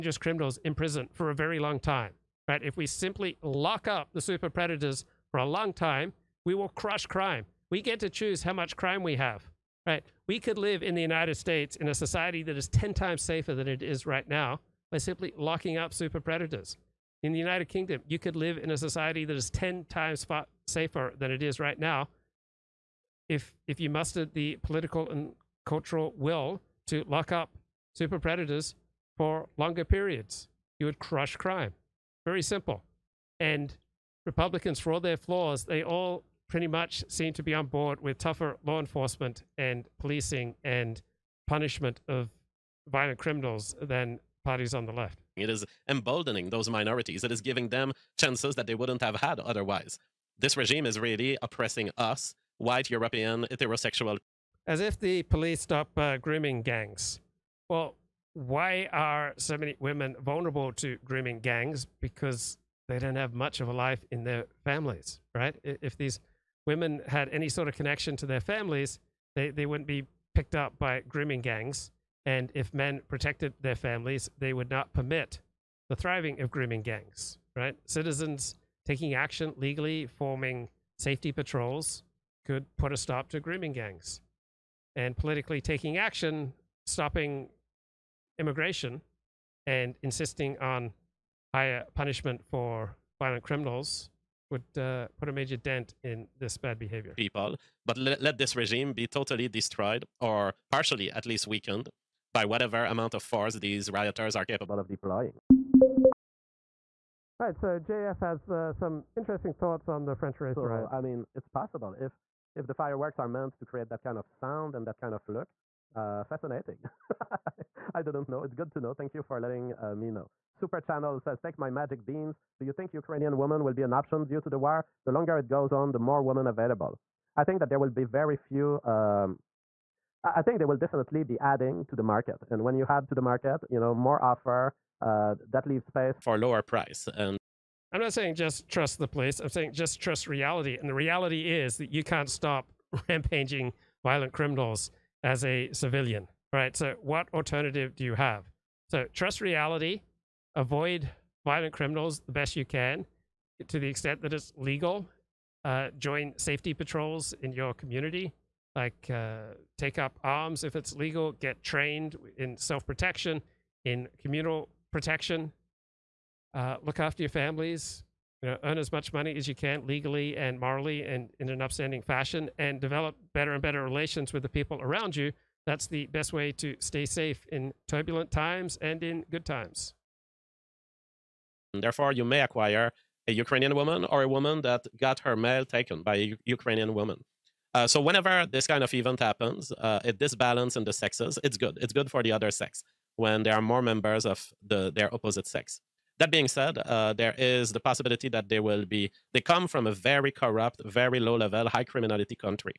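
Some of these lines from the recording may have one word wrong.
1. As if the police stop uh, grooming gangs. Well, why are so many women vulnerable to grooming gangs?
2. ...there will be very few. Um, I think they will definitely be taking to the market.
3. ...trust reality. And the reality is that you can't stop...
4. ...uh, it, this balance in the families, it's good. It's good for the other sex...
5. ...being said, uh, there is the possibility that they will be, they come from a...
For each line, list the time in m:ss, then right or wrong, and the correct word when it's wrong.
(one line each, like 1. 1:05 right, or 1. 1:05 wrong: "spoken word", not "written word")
1. 0:54 right
2. 2:07 wrong: "adding", not "taking"
3. 2:19 right
4. 3:09 wrong: "sexes", not "families"
5. 3:16 right.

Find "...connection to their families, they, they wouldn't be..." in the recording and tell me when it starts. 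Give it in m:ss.
1:07.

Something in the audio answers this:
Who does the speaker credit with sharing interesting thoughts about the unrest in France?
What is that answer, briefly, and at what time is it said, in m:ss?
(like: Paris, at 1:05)
JF, at 1:47.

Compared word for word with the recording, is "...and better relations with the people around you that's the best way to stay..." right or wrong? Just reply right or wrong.
right.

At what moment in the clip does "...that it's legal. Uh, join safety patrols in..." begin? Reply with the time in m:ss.
2:34.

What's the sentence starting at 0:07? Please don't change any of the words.
We get to choose how much crime we have, right?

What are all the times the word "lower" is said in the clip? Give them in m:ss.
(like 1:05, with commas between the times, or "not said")
2:16.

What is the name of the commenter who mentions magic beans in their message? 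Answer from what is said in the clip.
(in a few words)
Super Channel.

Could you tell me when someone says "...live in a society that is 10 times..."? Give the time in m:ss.
0:18.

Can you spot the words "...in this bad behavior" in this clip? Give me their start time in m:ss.
1:36.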